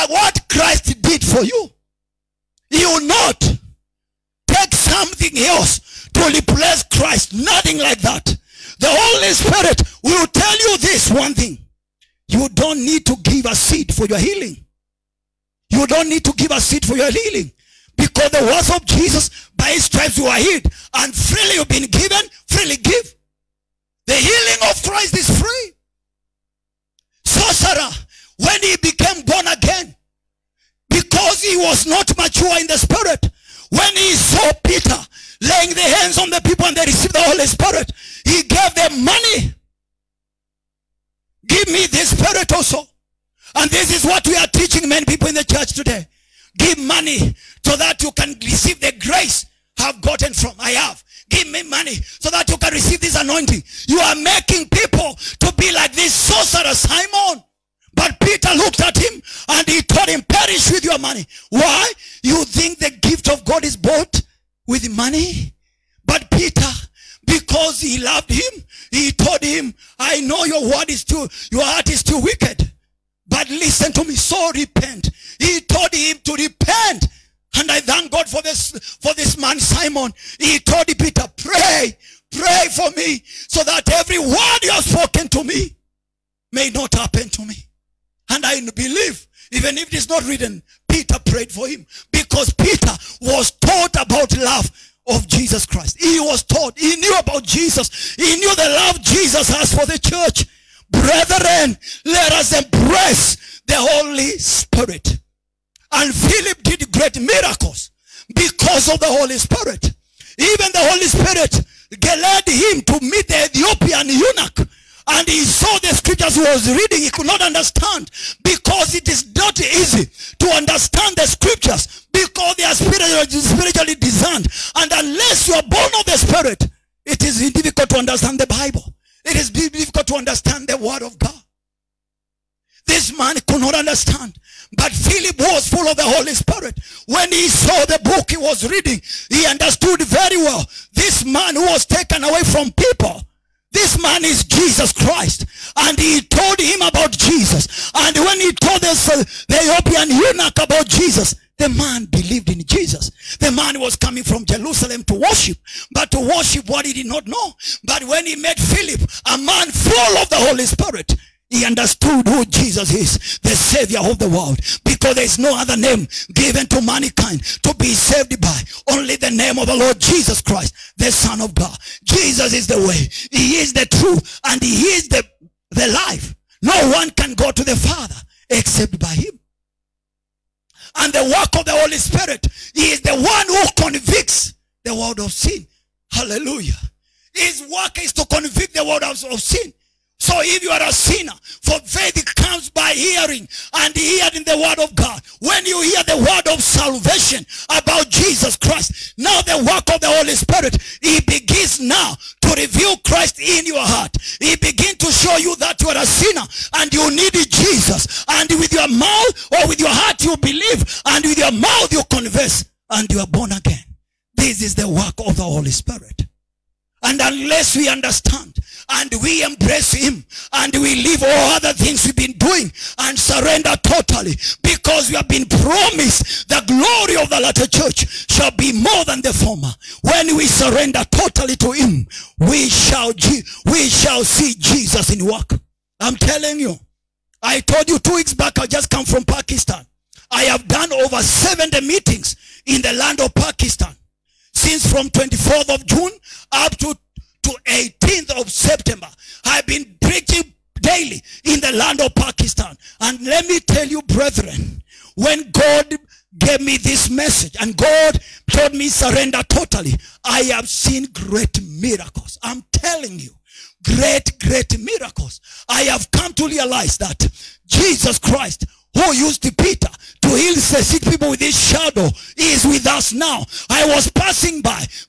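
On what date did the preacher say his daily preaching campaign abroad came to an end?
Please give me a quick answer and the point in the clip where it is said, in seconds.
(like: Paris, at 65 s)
18th of September, at 247 s.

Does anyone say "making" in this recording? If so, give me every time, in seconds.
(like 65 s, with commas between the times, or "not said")
54 s.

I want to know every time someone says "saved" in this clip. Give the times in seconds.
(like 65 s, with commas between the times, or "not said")
167 s.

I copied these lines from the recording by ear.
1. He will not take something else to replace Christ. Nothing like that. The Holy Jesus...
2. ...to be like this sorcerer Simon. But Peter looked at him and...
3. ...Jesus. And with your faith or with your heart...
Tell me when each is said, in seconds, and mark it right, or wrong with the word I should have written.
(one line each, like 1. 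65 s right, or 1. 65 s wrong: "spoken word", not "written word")
1. 2 s wrong: "Spirit", not "Jesus"
2. 55 s right
3. 207 s wrong: "mouth", not "faith".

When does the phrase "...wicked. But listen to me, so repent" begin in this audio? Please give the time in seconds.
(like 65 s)
72 s.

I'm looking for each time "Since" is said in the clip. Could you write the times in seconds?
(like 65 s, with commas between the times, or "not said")
244 s.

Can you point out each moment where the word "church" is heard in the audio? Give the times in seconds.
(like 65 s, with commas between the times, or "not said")
45 s, 100 s, 227 s.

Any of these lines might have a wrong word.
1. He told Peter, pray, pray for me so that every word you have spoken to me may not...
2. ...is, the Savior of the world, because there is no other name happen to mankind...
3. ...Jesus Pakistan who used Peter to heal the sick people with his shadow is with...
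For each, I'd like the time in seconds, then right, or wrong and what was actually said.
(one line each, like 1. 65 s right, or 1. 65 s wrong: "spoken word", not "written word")
1. 80 s right
2. 162 s wrong: "given", not "happen"
3. 267 s wrong: "Christ", not "Pakistan".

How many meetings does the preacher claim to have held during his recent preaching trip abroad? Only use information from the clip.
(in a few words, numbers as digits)
over 70.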